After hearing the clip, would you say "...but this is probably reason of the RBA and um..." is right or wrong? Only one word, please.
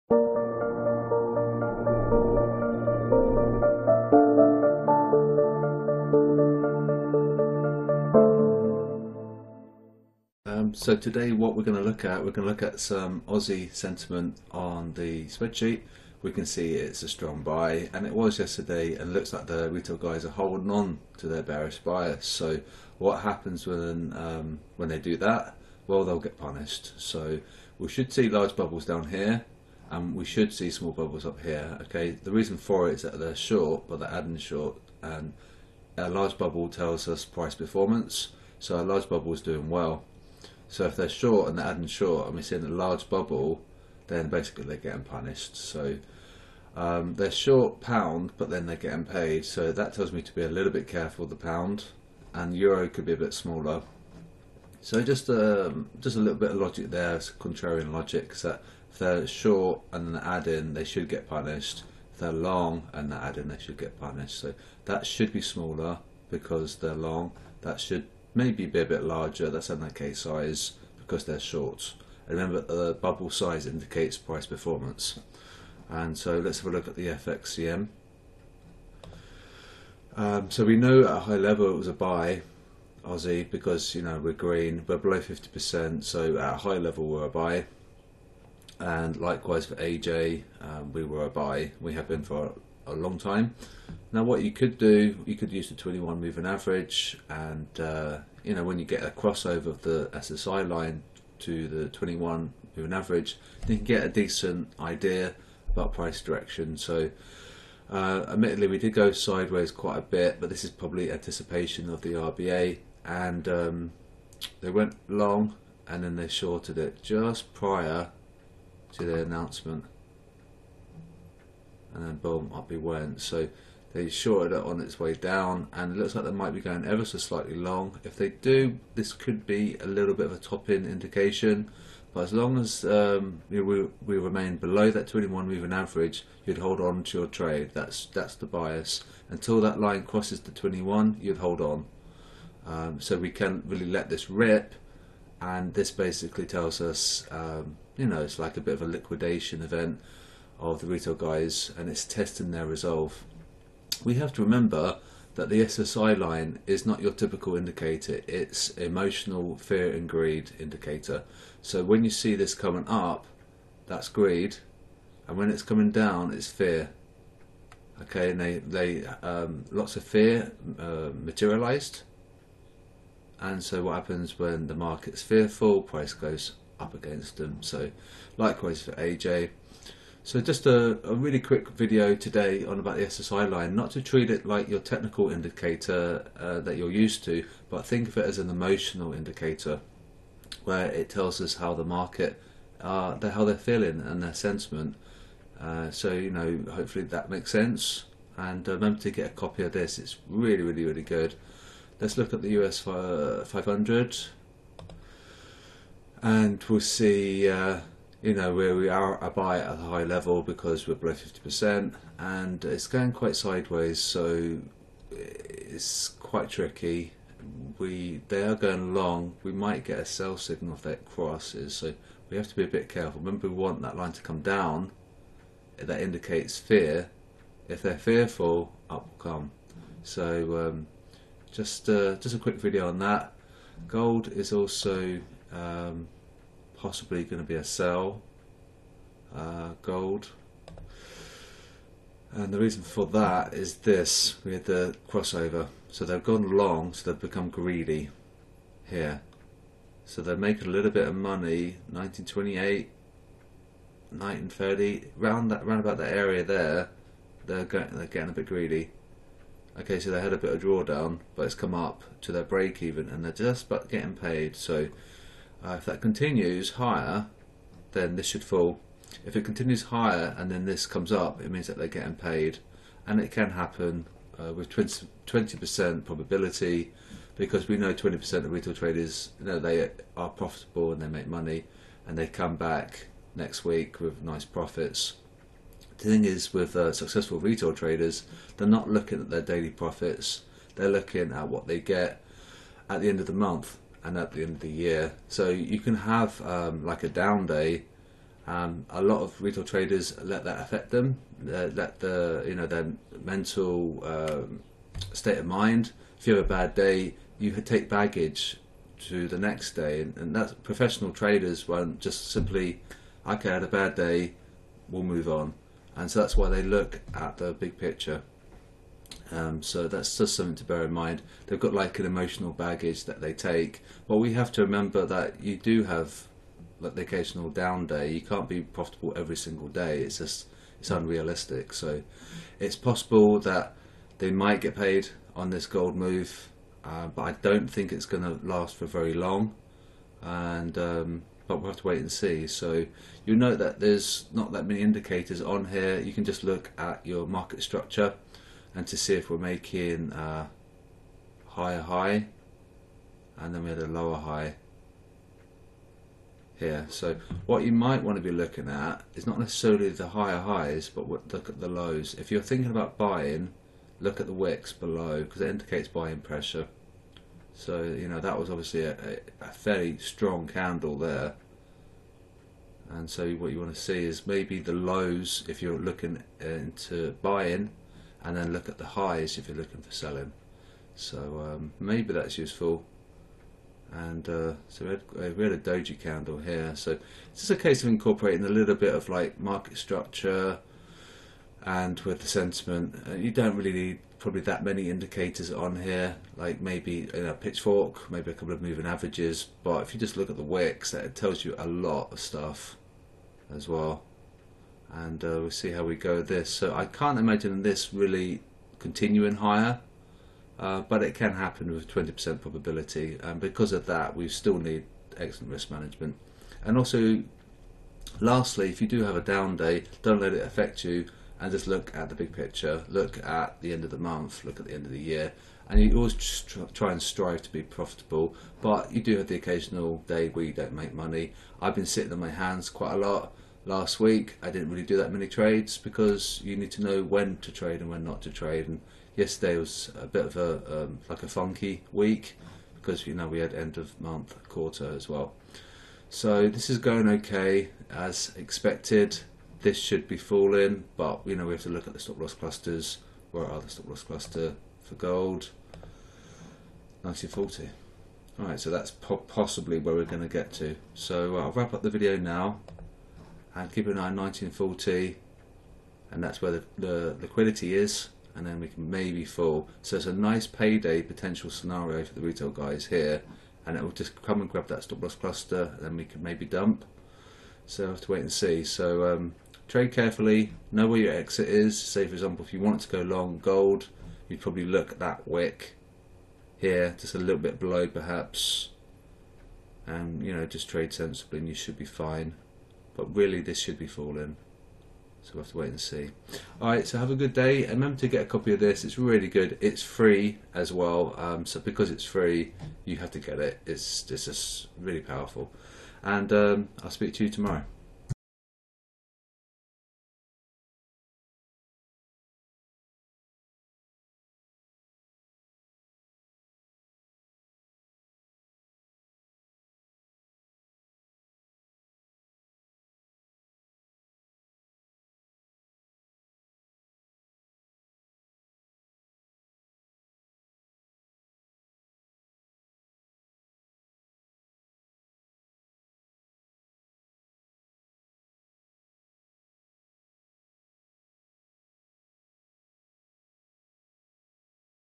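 wrong.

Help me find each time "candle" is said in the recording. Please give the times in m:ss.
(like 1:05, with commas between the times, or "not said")
6:10, 6:25.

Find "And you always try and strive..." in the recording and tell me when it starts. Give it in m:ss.
7:05.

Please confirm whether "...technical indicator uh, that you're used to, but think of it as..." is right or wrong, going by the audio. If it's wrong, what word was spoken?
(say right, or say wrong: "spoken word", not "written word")
right.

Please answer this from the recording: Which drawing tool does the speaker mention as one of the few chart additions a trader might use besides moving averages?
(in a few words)
Pitchfork.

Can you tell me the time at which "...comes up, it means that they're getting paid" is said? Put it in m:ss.
4:30.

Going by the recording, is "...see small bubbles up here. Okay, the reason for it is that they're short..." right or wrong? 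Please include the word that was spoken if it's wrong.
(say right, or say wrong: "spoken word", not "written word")
right.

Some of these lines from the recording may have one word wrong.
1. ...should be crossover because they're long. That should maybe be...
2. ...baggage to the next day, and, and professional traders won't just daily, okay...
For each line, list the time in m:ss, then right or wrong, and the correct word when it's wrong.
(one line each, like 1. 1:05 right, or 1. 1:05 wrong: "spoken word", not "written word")
1. 1:05 wrong: "smaller", not "crossover"
2. 5:07 wrong: "simply", not "daily".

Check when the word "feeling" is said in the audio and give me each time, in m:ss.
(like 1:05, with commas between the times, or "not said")
3:13.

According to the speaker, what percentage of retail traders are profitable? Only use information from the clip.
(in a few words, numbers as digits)
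20%.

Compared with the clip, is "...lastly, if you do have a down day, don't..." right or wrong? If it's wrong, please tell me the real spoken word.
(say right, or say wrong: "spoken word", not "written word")
right.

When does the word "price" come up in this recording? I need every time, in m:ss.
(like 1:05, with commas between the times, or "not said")
0:37, 1:14, 1:45, 2:55.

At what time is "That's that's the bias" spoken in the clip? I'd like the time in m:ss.
2:17.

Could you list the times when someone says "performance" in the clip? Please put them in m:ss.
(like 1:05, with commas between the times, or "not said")
0:37, 1:14.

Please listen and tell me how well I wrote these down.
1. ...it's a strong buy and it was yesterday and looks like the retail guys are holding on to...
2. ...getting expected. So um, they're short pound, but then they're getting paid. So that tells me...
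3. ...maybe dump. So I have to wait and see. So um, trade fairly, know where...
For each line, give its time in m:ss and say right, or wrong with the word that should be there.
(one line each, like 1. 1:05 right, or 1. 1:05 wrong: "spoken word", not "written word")
1. 0:16 right
2. 0:44 wrong: "punished", not "expected"
3. 7:56 wrong: "carefully", not "fairly".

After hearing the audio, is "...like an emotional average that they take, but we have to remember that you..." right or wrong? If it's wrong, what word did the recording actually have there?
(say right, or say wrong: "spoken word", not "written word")
wrong: "baggage", not "average".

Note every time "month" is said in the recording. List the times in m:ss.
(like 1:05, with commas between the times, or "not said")
4:53, 7:03, 7:24.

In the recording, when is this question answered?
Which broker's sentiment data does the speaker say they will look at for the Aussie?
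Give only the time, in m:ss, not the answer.
1:17.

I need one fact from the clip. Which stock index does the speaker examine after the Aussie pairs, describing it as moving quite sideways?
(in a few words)
US 500.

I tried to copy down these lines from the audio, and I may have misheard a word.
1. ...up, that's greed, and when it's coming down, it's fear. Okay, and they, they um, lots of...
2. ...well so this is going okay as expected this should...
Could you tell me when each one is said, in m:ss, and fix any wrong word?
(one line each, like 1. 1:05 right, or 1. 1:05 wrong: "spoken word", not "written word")
1. 2:42 right
2. 7:25 right.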